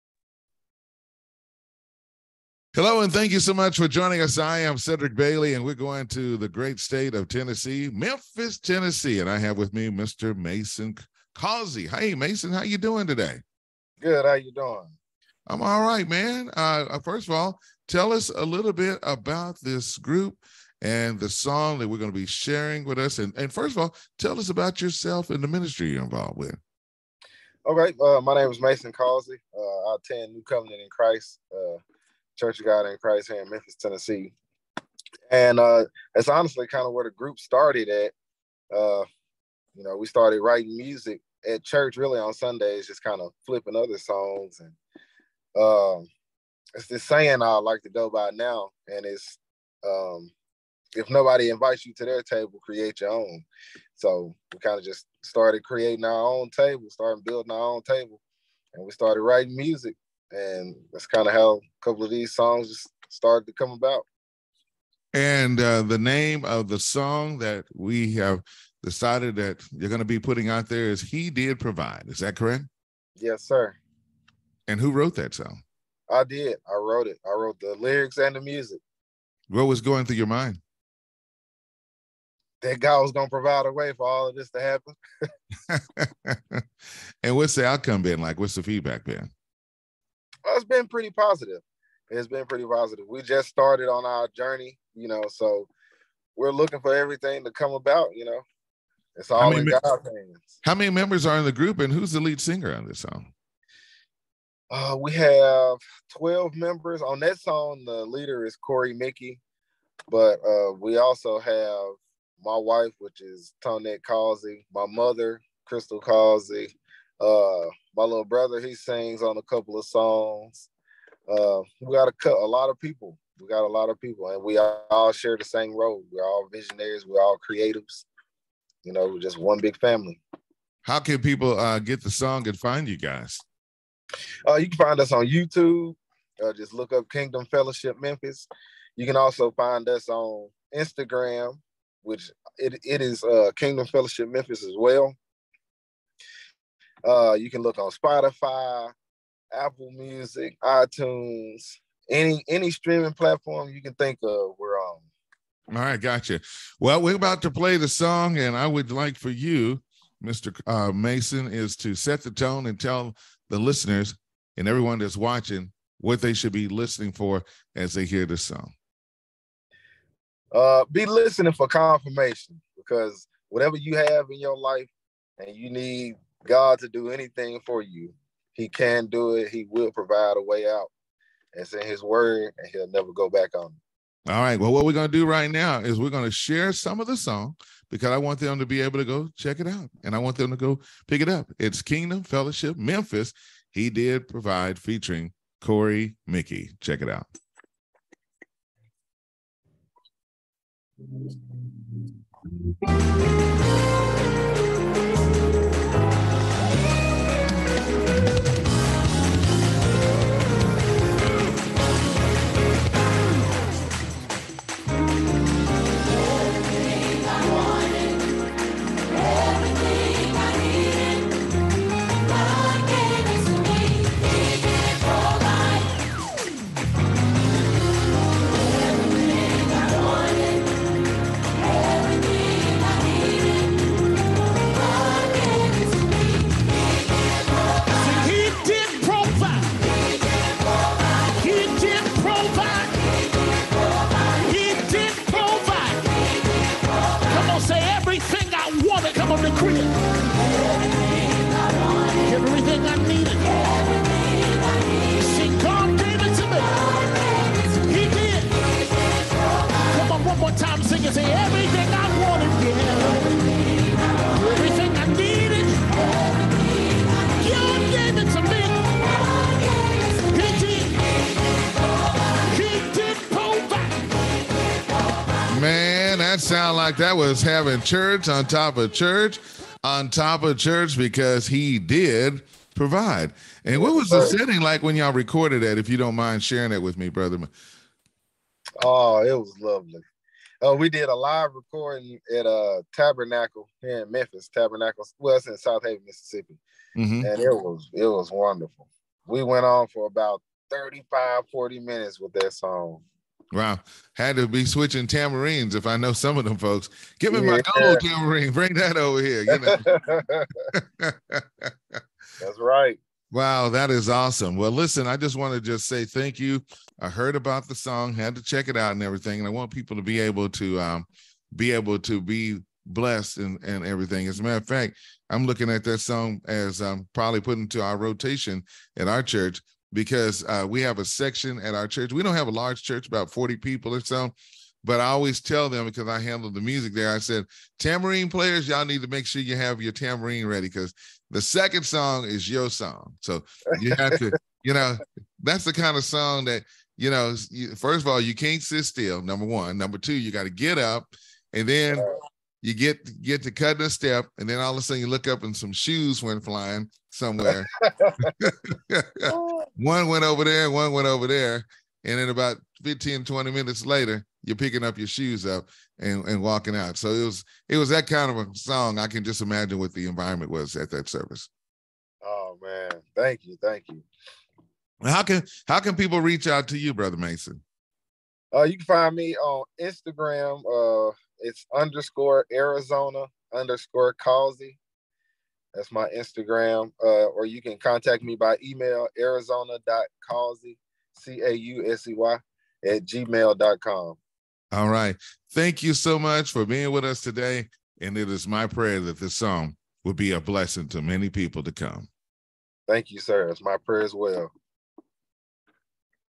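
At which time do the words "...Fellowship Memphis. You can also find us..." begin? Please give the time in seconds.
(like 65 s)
137 s.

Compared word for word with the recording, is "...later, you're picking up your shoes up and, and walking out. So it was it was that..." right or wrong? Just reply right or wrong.
right.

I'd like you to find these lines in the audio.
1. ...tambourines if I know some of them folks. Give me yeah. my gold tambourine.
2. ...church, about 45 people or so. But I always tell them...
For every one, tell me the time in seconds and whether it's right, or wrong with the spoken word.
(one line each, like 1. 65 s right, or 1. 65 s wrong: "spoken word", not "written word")
1. 305 s right
2. 332 s wrong: "40", not "45".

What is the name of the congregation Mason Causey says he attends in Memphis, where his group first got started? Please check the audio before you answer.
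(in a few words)
New Covenant in Christ.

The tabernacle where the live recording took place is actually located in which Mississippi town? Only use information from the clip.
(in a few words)
Southaven.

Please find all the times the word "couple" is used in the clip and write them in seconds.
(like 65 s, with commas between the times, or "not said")
61 s, 119 s.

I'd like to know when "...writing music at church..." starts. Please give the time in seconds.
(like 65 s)
40 s.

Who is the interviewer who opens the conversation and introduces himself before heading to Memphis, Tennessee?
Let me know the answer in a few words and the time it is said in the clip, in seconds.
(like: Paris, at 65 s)
Cedric Bailey, at 4 s.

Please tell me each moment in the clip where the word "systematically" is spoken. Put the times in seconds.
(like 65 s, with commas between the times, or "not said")
not said.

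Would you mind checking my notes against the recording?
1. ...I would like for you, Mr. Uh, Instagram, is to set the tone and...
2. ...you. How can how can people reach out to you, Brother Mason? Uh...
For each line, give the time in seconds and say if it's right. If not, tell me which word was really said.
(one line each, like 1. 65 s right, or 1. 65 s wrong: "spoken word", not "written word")
1. 158 s wrong: "Mason", not "Instagram"
2. 373 s right.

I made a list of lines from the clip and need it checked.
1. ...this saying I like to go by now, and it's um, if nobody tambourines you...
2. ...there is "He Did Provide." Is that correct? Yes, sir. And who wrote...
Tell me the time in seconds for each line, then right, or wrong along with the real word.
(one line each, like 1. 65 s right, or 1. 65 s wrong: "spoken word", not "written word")
1. 46 s wrong: "invites", not "tambourines"
2. 70 s right.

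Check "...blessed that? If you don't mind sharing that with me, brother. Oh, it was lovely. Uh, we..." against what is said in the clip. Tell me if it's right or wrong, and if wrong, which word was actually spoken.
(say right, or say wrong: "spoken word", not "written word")
wrong: "recorded", not "blessed".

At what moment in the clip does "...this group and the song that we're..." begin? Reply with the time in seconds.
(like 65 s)
19 s.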